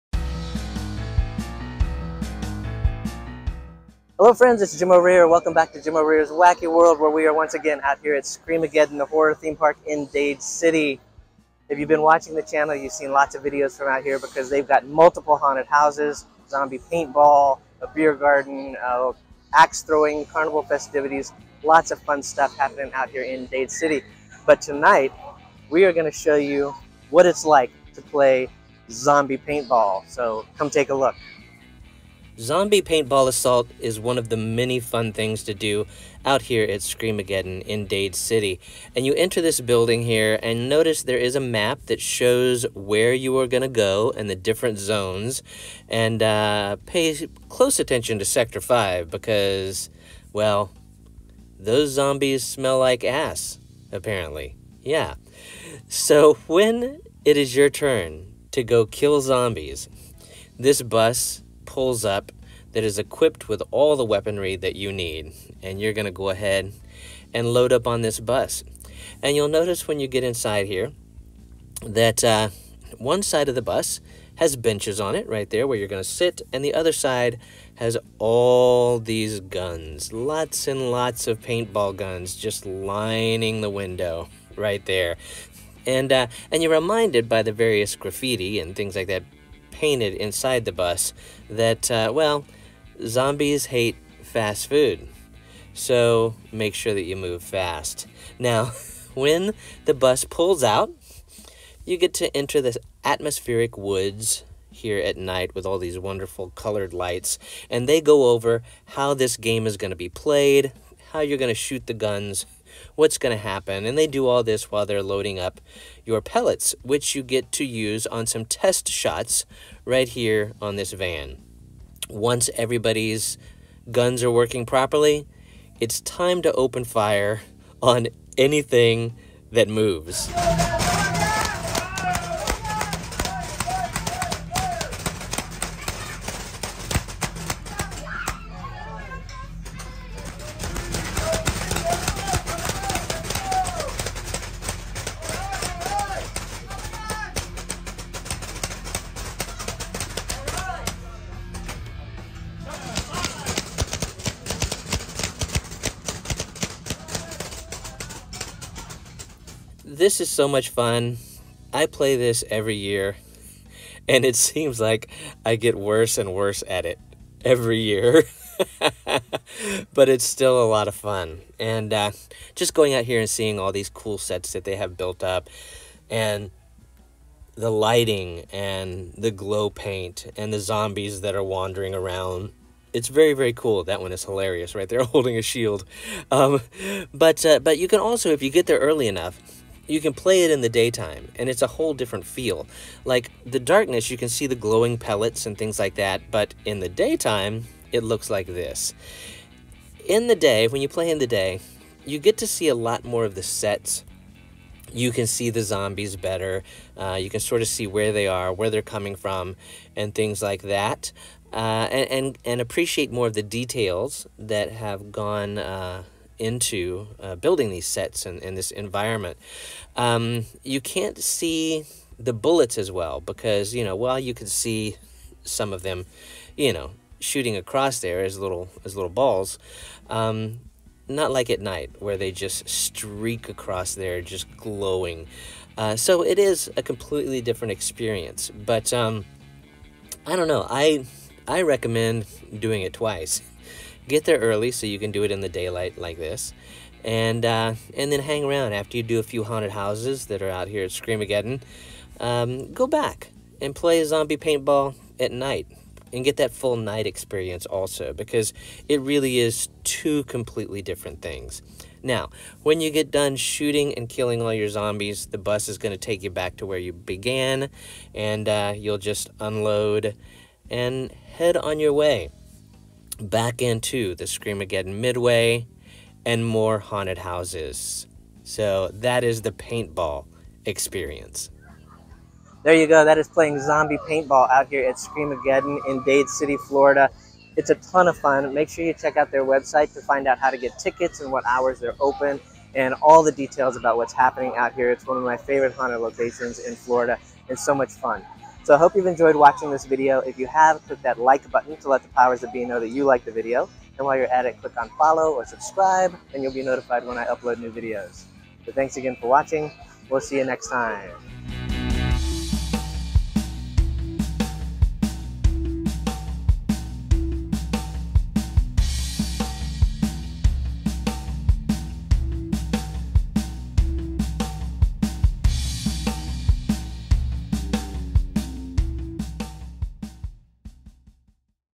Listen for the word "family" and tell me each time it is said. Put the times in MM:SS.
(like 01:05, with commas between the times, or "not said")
not said.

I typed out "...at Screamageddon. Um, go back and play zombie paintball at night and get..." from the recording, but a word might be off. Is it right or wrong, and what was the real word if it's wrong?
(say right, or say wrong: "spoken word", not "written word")
right.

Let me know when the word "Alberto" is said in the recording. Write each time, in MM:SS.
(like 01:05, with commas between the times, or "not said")
not said.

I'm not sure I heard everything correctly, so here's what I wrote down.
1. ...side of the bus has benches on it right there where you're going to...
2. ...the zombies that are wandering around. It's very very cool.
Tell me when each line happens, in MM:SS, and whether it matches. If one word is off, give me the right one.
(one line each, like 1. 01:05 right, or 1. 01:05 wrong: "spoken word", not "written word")
1. 01:13 right
2. 03:00 right.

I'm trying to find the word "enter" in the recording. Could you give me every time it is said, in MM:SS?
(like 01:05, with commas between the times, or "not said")
00:39, 01:42.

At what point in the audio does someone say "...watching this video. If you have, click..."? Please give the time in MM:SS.
04:59.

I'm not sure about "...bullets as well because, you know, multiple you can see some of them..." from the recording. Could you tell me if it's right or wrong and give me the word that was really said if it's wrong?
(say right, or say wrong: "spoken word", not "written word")
wrong: "while", not "multiple".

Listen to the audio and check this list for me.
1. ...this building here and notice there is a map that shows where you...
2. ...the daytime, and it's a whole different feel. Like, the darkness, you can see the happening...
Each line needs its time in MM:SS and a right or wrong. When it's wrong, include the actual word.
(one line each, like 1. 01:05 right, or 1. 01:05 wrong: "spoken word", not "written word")
1. 00:39 right
2. 03:10 wrong: "glowing", not "happening".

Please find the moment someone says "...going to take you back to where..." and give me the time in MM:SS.
04:25.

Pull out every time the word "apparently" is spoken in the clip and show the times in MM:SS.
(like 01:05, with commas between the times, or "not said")
00:53.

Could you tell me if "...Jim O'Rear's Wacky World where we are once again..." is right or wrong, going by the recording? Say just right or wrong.
right.